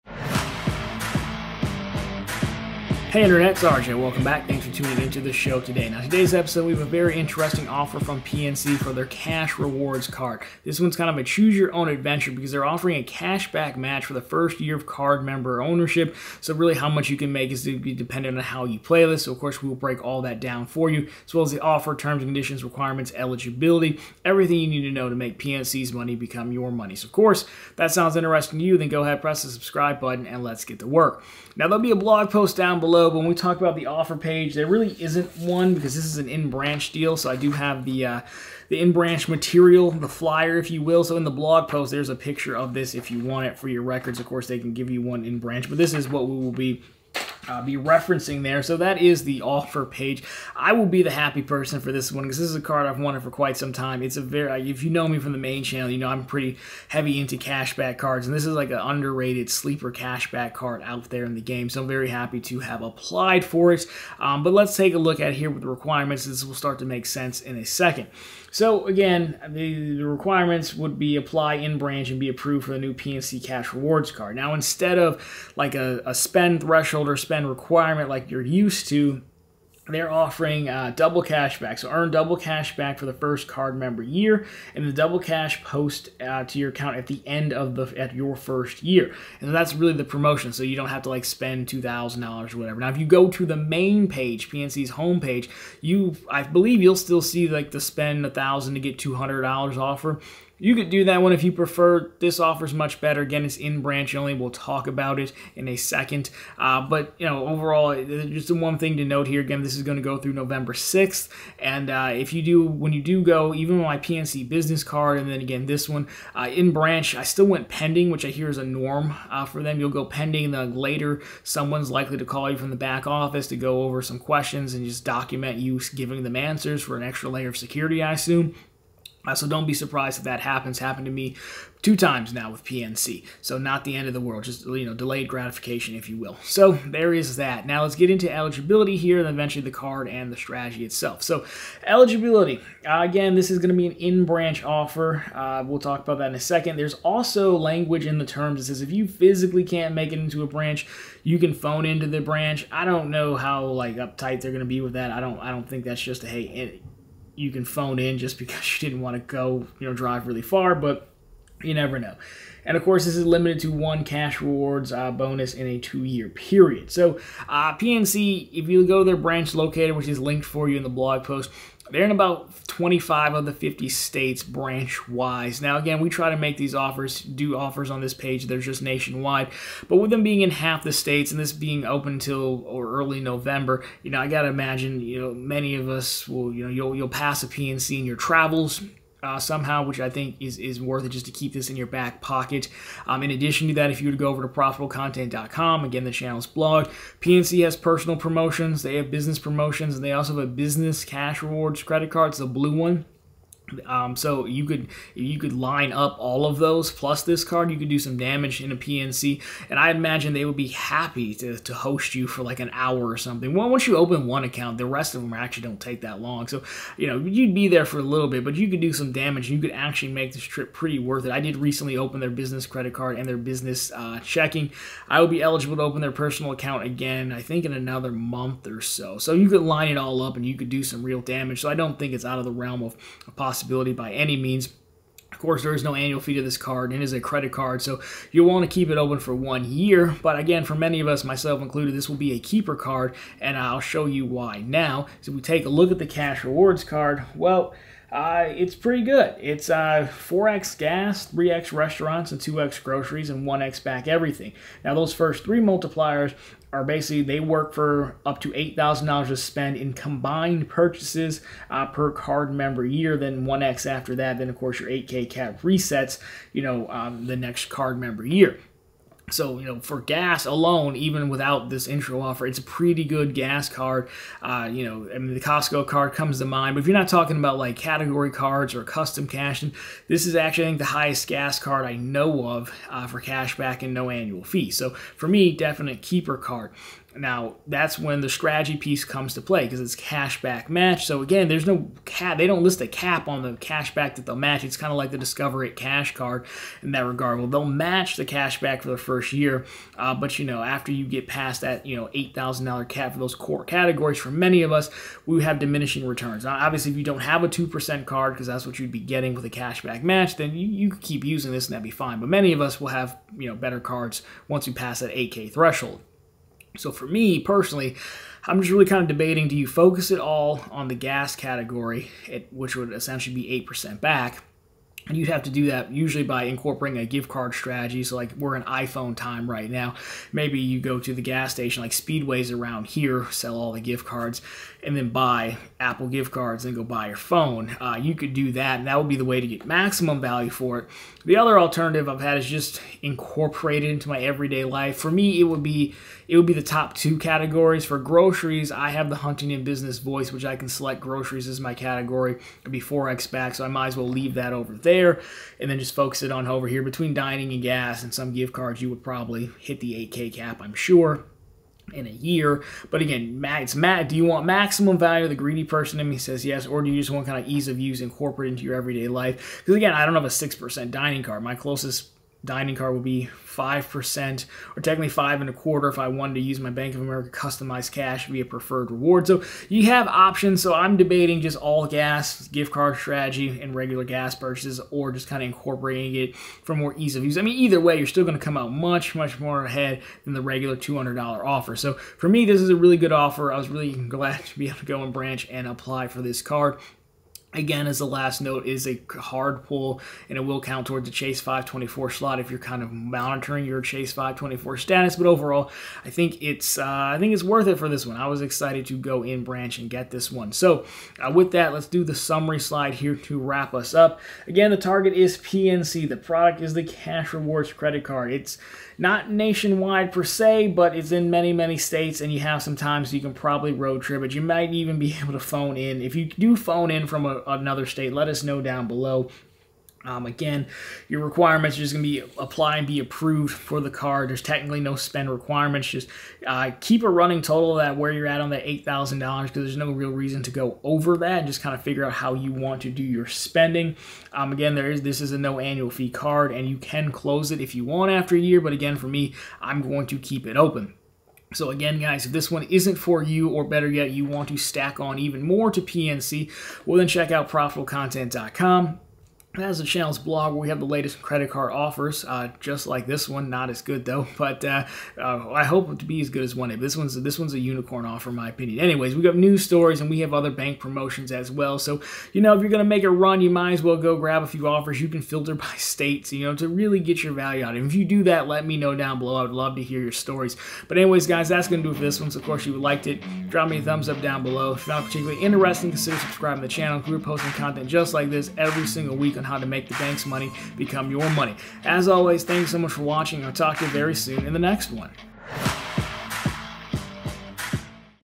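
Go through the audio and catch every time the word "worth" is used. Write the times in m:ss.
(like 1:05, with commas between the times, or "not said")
3:10, 3:40, 6:47.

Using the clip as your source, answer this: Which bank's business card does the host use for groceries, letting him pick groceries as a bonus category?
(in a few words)
Huntington.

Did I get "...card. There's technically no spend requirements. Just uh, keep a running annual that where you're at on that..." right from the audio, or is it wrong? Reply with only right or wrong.
wrong.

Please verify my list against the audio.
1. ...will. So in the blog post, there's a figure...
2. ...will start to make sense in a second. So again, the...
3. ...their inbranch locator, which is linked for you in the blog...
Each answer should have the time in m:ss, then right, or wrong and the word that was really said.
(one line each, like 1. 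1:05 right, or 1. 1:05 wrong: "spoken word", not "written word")
1. 0:40 wrong: "picture", not "figure"
2. 1:06 right
3. 2:49 wrong: "branch", not "inbranch".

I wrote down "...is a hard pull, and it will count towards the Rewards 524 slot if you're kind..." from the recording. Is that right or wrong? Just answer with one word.
wrong.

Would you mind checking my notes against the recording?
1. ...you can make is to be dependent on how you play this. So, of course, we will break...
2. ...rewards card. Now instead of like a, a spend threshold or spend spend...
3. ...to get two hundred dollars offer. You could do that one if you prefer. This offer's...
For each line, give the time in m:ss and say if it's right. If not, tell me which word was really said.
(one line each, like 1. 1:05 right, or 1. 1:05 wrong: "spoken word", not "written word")
1. 0:17 right
2. 1:13 right
3. 1:38 right.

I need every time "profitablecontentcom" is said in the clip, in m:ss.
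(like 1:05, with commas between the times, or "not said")
3:14, 7:37.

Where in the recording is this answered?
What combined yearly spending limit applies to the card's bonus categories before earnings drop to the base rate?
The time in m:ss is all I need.
4:18.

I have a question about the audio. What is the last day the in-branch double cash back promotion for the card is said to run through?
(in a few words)
November 6th.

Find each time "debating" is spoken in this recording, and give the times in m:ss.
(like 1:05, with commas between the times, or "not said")
5:19, 6:20.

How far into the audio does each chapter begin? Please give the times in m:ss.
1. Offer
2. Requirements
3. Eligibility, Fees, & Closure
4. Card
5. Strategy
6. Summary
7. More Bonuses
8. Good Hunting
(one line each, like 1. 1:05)
1. 0:31
2. 1:04
3. 2:18
4. 4:04
5. 4:47
6. 6:50
7. 7:30
8. 8:00.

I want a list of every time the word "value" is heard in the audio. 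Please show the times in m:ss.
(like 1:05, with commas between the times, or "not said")
5:40, 6:04, 7:57.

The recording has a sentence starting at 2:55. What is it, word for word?
Now, again, we try to make these offers, do offers on this page.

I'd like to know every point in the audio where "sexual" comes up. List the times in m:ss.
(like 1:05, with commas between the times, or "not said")
not said.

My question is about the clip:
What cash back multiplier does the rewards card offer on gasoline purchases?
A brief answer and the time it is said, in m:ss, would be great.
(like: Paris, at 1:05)
4x, at 4:10.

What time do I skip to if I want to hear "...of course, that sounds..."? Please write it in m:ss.
0:27.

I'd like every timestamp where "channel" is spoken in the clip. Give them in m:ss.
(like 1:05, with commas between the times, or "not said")
0:55, 3:16, 7:39, 8:06.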